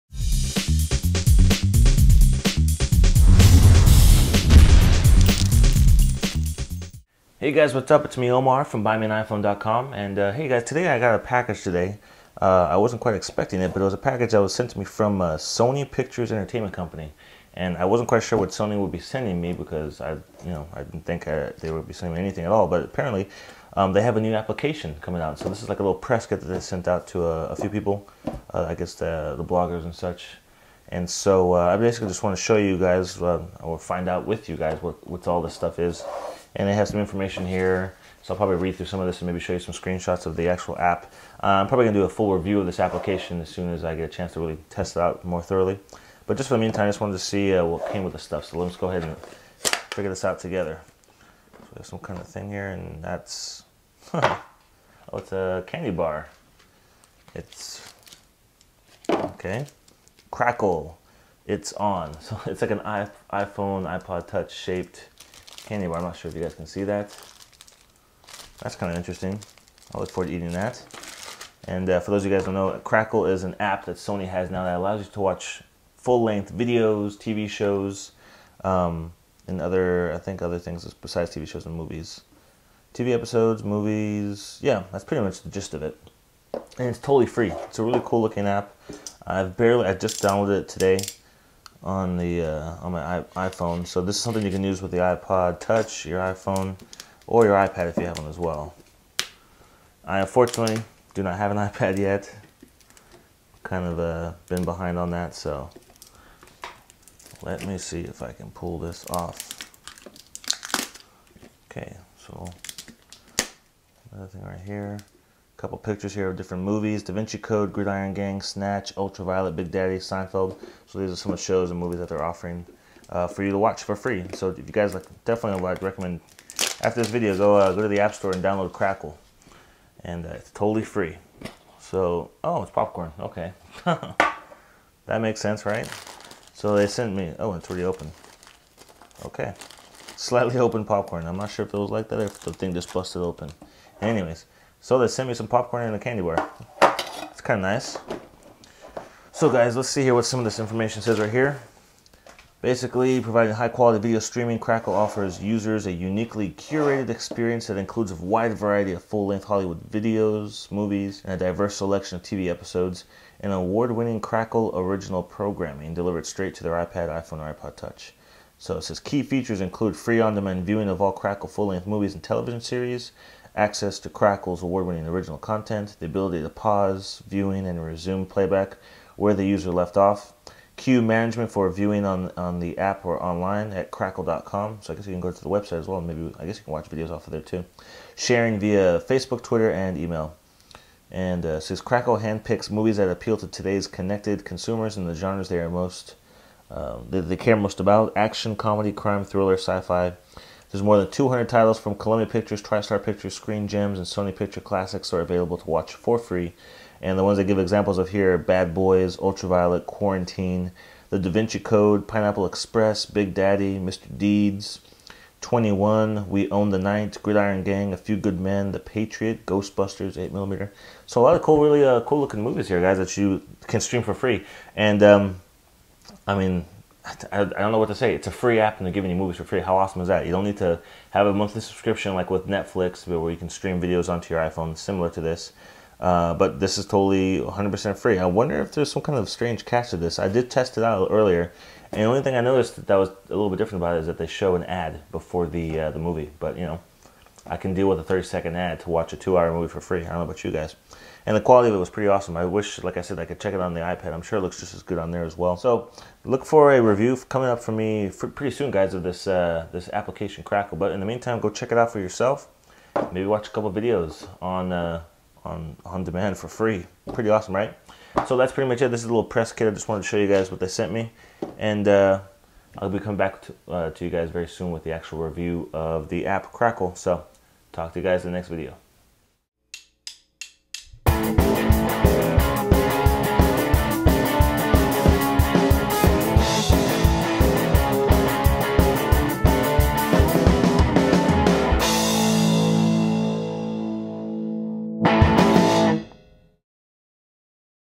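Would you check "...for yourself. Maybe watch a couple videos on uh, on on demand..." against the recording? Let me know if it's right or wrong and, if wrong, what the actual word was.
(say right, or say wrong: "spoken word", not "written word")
right.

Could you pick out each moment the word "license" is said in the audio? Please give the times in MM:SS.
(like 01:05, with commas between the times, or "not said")
not said.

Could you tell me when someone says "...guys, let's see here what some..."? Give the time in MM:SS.
02:29.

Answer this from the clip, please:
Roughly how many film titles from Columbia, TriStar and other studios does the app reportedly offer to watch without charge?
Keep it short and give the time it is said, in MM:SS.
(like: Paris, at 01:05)
more than 200, at 03:20.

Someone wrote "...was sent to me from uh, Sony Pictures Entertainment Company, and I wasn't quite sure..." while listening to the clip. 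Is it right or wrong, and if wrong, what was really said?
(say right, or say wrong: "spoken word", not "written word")
right.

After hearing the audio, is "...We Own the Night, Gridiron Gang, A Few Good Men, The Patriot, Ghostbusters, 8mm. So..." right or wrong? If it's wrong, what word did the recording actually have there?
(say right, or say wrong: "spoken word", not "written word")
right.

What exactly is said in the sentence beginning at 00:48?
So let's go ahead and figure this out together.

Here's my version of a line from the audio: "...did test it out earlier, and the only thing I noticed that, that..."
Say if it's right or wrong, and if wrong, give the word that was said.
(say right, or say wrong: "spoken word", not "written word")
right.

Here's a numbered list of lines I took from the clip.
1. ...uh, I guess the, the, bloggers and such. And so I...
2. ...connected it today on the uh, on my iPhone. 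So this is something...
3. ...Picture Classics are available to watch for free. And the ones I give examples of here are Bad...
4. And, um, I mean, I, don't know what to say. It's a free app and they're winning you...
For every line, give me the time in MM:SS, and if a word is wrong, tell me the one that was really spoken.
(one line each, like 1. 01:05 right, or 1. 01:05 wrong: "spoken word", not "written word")
1. 00:28 right
2. 01:30 wrong: "downloaded", not "connected"
3. 03:24 right
4. 03:44 wrong: "giving", not "winning".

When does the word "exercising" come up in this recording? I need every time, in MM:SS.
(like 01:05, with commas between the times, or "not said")
not said.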